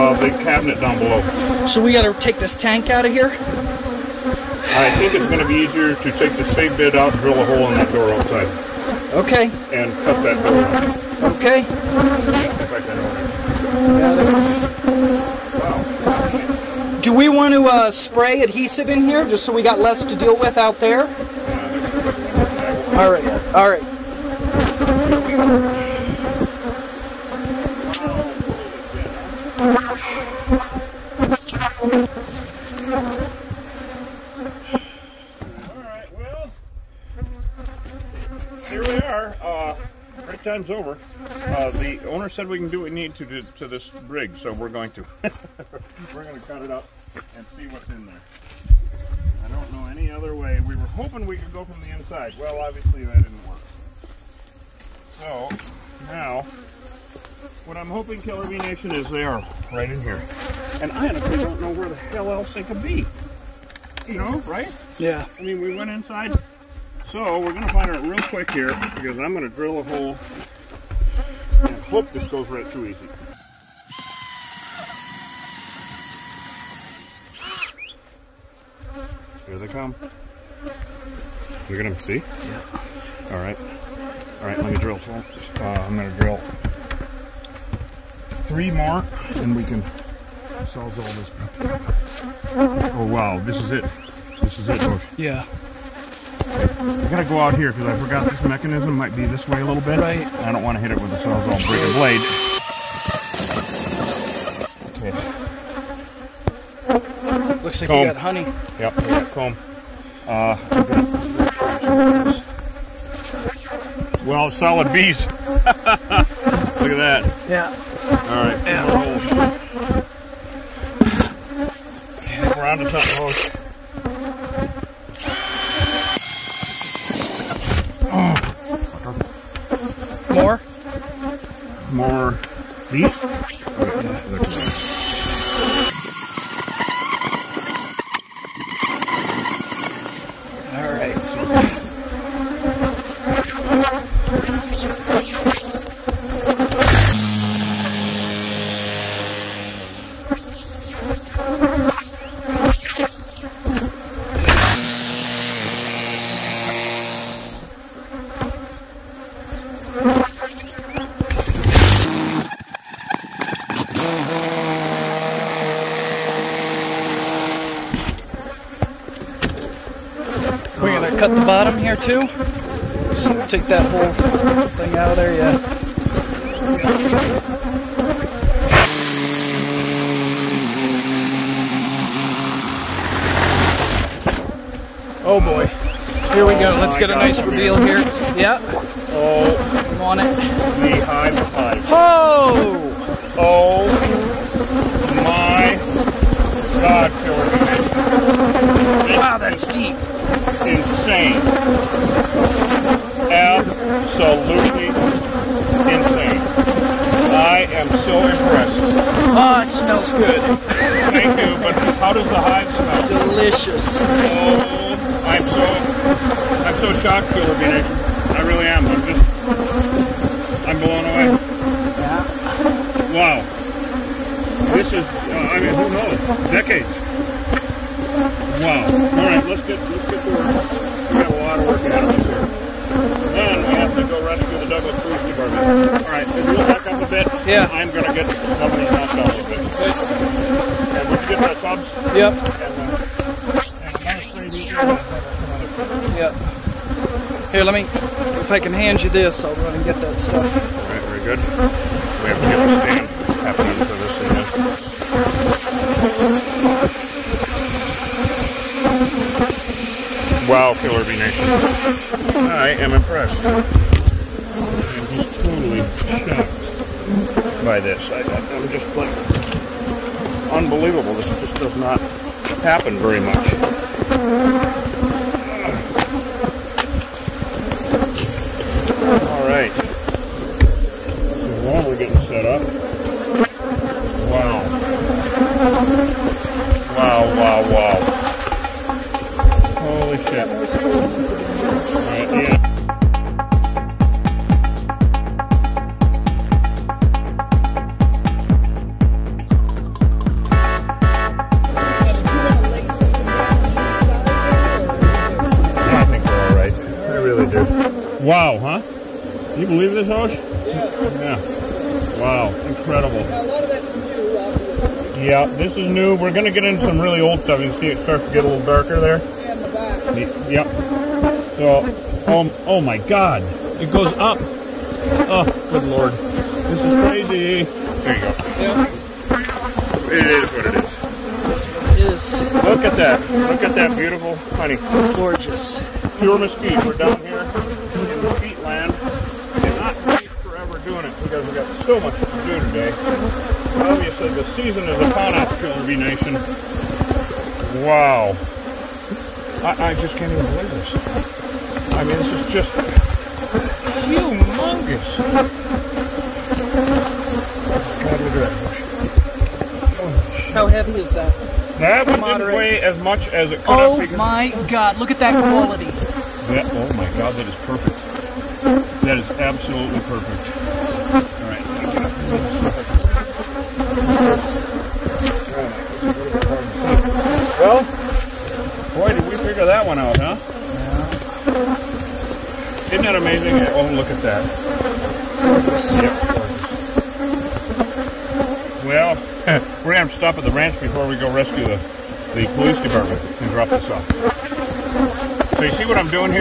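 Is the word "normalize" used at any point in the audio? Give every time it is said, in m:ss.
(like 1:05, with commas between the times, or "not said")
not said.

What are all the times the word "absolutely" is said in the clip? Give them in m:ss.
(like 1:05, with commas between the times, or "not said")
3:23, 6:09.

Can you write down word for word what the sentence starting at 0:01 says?
So we gotta take this tank out of here?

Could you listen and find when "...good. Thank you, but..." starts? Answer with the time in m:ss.
3:30.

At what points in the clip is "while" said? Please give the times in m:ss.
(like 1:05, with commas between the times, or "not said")
4:41.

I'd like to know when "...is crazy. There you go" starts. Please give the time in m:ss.
5:26.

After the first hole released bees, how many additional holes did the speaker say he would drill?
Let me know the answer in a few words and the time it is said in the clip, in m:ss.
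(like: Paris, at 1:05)
3, at 1:28.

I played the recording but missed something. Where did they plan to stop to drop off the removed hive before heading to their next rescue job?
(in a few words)
the ranch.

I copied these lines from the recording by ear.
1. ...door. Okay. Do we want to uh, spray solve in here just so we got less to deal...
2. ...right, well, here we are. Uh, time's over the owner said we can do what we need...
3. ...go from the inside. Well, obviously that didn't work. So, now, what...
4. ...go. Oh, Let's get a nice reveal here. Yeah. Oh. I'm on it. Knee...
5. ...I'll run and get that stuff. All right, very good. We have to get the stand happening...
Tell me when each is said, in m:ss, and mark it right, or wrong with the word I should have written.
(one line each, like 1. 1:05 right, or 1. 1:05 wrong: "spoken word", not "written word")
1. 0:10 wrong: "adhesive", not "solve"
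2. 0:35 right
3. 0:51 right
4. 3:06 right
5. 4:09 right.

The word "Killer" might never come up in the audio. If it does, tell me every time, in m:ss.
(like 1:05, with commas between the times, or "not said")
0:58, 4:20.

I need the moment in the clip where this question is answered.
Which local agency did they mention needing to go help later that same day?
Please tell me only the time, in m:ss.
3:54.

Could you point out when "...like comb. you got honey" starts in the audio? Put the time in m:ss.
1:47.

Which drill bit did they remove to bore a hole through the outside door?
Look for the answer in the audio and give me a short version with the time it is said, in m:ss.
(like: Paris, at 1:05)
spade bit, at 0:06.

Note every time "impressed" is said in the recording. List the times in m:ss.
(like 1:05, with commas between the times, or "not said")
3:28, 4:22.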